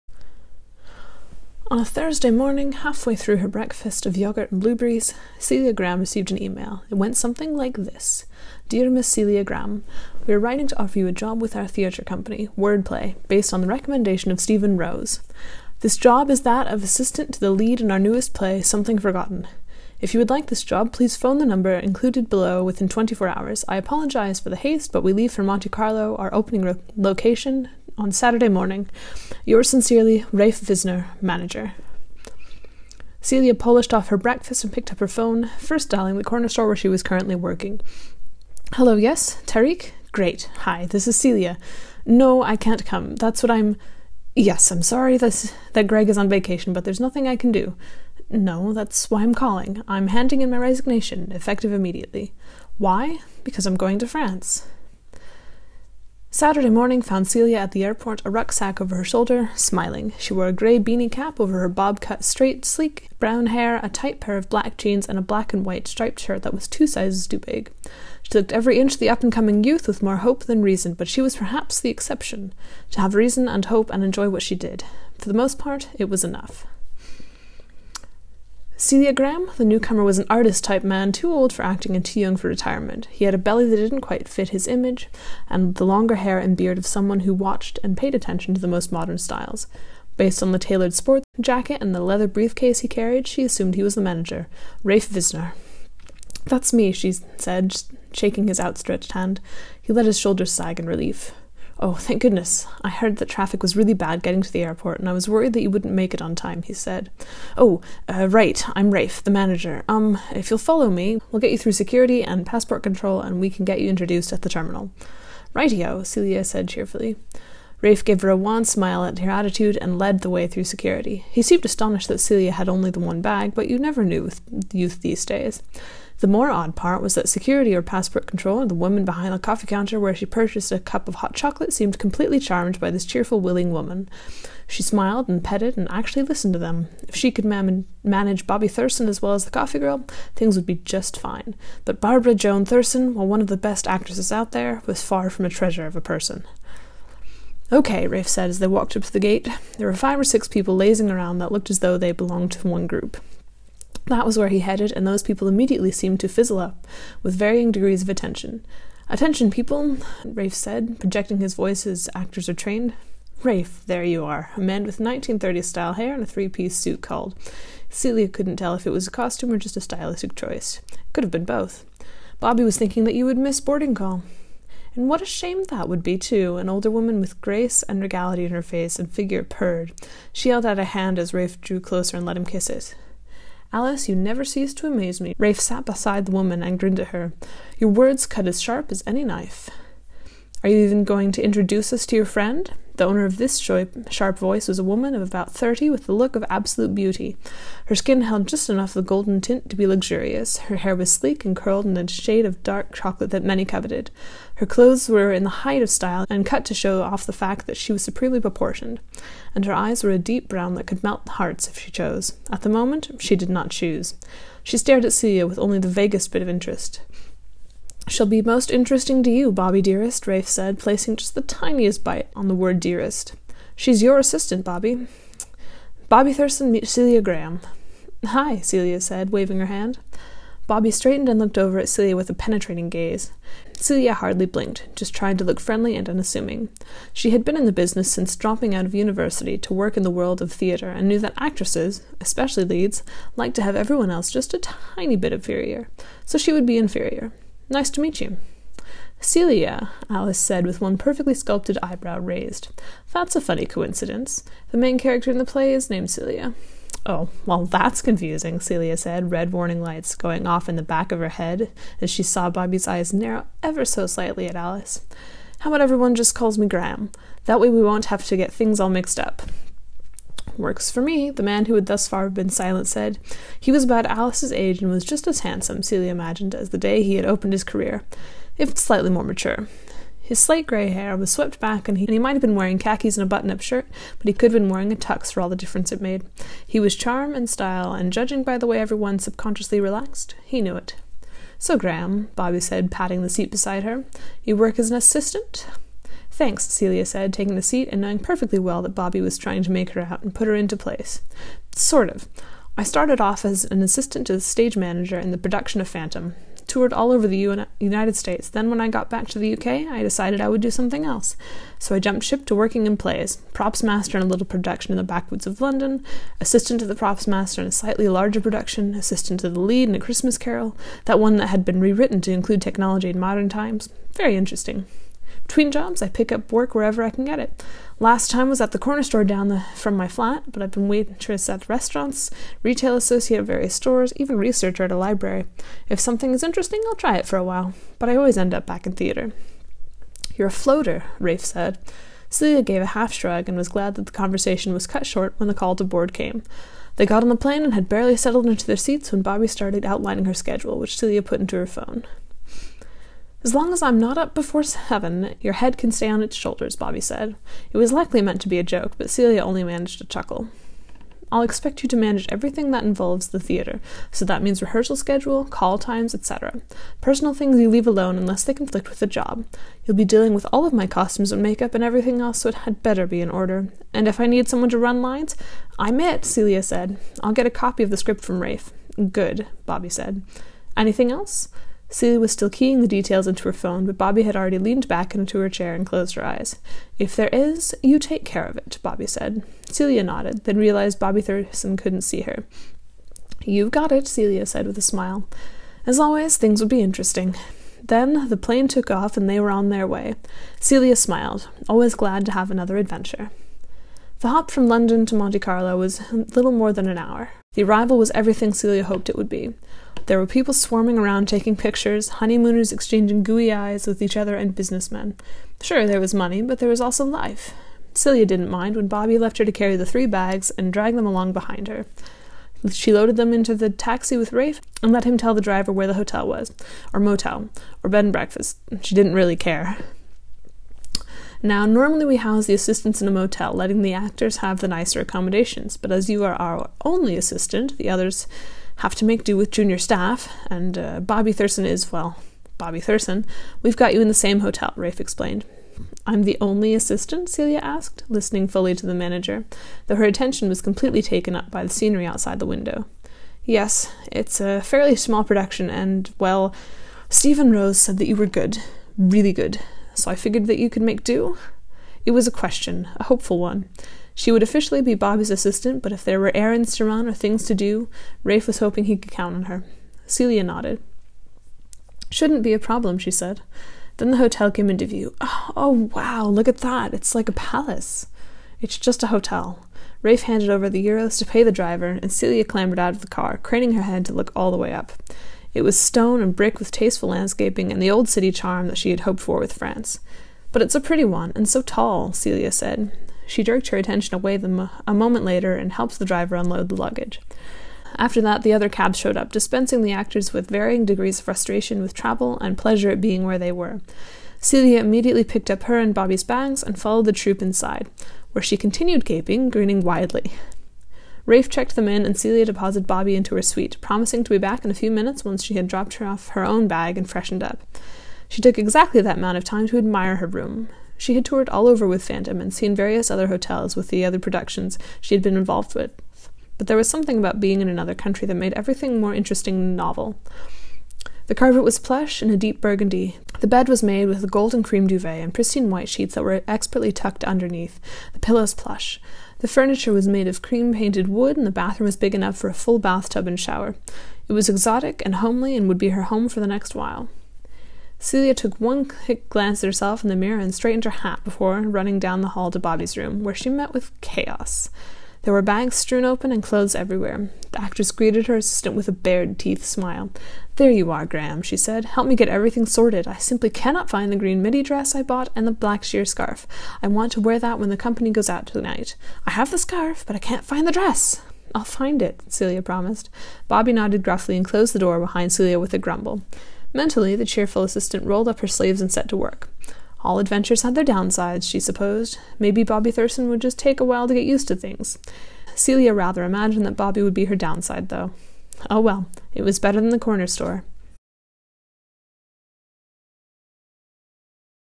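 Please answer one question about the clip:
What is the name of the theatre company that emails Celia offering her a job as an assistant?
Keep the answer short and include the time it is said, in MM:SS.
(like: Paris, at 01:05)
Wordplay, at 00:12.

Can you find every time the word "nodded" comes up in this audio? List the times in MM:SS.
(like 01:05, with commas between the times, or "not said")
06:30, 07:50, 09:33.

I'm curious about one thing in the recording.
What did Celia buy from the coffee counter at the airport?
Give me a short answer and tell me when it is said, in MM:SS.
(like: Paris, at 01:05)
Hot chocolate, at 02:11.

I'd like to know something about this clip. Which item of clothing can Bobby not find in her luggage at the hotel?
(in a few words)
Green midi dress.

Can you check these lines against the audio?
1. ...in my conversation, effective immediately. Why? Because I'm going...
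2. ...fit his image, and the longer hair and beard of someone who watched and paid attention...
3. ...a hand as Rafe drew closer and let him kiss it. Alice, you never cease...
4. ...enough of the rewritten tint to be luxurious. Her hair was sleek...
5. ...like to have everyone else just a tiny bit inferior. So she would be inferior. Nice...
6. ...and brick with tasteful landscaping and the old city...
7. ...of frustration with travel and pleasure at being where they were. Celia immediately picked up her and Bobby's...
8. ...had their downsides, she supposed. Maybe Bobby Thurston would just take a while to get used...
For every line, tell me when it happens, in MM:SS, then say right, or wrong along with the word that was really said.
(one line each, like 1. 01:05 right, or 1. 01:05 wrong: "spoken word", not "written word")
1. 00:50 wrong: "resignation", not "conversation"
2. 01:24 right
3. 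03:00 right
4. 03:18 wrong: "golden", not "rewritten"
5. 04:03 right
6. 08:06 right
7. 08:21 right
8. 09:40 right.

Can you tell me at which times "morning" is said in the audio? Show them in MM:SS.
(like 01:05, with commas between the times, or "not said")
00:02, 00:28, 00:56.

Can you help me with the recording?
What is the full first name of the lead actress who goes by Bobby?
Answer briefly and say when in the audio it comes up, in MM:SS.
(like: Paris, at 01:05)
Barbara Joan, at 02:21.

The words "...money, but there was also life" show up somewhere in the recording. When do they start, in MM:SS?
06:56.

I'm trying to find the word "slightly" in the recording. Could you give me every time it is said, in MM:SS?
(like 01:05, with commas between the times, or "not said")
04:24, 04:38, 05:17.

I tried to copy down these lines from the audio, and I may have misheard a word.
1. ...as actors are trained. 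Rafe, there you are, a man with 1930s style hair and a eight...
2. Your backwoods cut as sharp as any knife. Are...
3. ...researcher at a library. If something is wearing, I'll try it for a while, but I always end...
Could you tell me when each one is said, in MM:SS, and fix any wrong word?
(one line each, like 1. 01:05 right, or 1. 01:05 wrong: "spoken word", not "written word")
1. 02:41 wrong: "three", not "eight"
2. 03:07 wrong: "words", not "backwoods"
3. 05:34 wrong: "interesting", not "wearing".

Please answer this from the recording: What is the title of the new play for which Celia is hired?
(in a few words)
Something Forgotten.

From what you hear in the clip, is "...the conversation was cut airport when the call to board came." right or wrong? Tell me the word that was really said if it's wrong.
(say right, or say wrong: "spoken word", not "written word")
wrong: "short", not "airport".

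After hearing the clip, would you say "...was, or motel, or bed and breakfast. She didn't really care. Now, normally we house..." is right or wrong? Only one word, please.
right.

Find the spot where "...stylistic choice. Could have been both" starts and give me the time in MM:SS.
02:49.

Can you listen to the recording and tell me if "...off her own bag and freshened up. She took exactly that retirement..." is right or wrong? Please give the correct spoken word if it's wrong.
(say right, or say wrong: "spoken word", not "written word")
wrong: "amount", not "retirement".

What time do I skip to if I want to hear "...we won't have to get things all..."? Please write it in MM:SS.
04:27.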